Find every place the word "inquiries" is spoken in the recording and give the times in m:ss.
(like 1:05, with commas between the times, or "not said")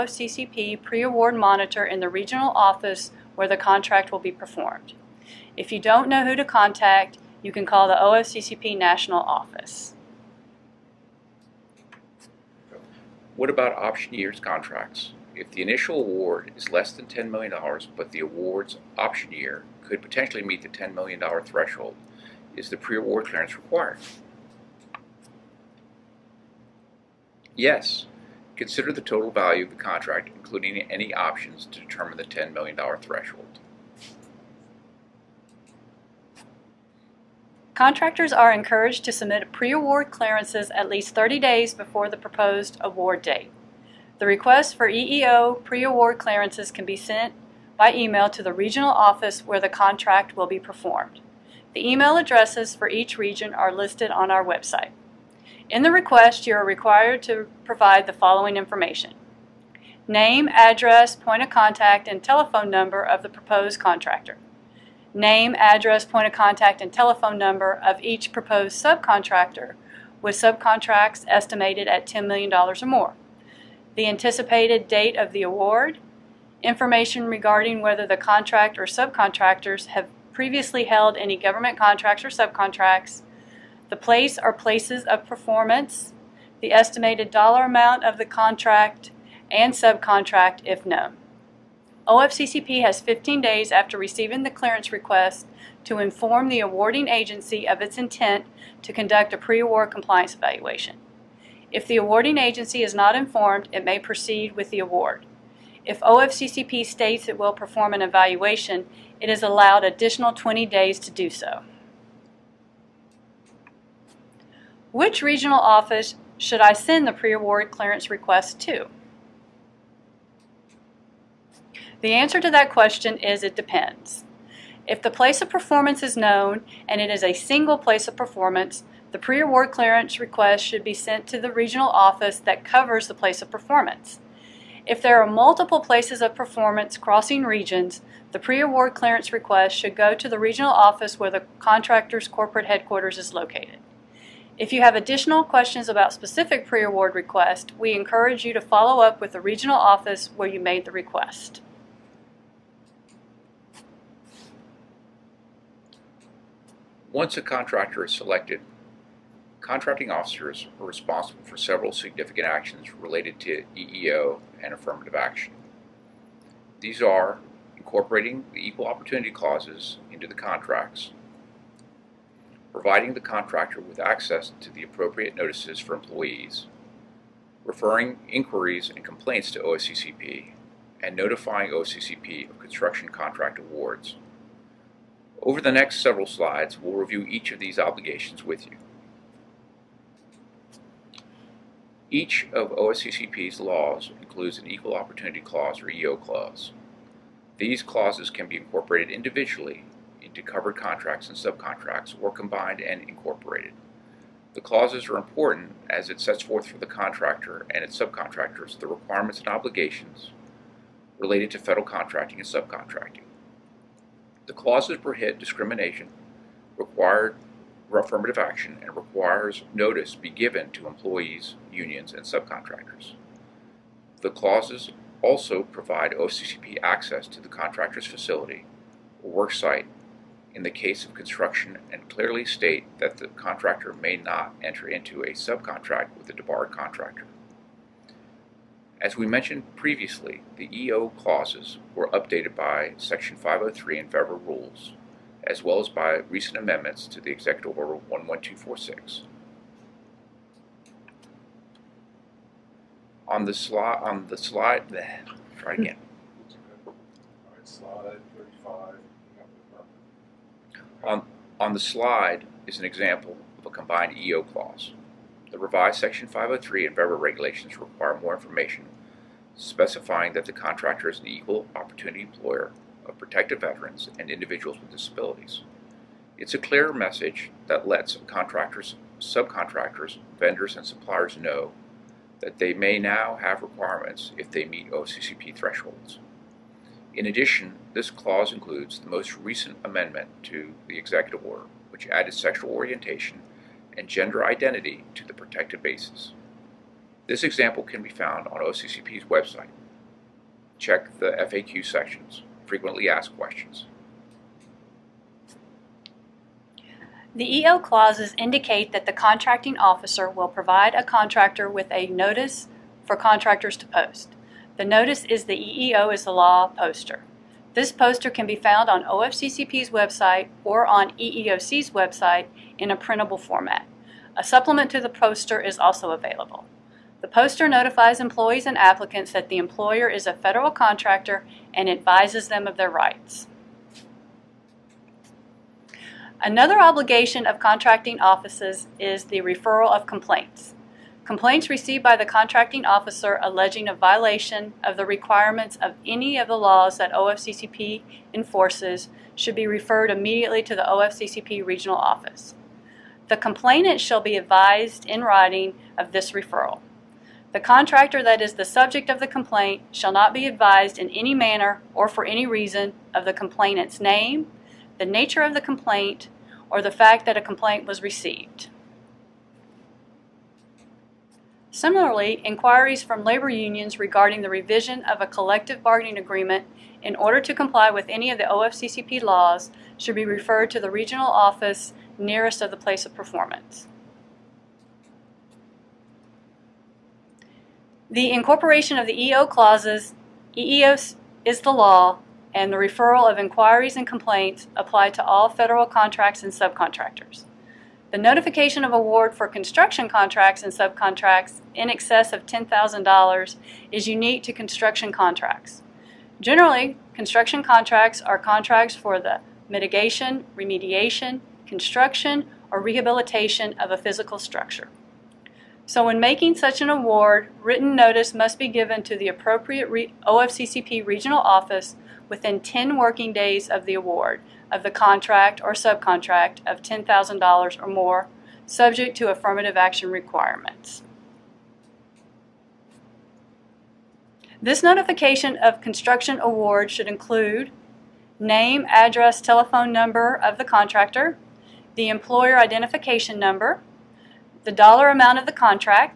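2:58, 6:12, 6:33.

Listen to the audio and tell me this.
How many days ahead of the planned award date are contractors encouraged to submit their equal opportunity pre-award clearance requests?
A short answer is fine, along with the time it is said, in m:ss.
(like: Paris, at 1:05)
30 days, at 0:41.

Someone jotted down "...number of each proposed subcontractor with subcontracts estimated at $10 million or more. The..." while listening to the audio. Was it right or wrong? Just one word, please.
right.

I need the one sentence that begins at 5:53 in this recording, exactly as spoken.
The complainant shall be advised in writing of this referral.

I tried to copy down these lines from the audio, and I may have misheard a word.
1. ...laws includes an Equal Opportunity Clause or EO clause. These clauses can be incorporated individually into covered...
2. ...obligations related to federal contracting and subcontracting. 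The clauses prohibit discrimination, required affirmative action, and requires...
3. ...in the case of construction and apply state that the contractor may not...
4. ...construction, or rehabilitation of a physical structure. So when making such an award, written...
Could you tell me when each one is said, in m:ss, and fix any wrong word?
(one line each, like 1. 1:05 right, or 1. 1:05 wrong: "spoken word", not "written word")
1. 3:13 right
2. 3:29 right
3. 3:50 wrong: "clearly", not "apply"
4. 6:51 right.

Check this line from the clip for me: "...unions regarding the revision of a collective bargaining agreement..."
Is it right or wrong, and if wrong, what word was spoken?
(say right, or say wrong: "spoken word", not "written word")
right.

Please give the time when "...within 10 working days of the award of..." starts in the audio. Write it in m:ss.
7:02.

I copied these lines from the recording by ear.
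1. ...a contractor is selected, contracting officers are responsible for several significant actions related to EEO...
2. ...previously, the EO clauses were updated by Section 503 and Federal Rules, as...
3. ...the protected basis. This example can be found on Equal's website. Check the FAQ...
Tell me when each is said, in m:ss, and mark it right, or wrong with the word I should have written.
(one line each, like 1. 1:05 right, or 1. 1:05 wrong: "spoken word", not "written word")
1. 2:37 right
2. 3:59 right
3. 4:55 wrong: "OFCCP", not "Equal".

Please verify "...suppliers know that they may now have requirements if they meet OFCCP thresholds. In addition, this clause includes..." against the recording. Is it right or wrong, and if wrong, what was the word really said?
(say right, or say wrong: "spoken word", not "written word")
right.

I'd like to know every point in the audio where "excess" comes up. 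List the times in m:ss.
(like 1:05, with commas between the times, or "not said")
6:41.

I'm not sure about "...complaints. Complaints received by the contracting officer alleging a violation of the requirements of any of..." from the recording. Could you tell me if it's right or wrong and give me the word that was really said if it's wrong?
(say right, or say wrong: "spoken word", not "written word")
right.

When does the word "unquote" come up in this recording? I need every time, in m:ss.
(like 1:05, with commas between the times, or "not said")
not said.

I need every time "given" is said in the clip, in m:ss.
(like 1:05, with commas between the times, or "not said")
3:40, 6:58.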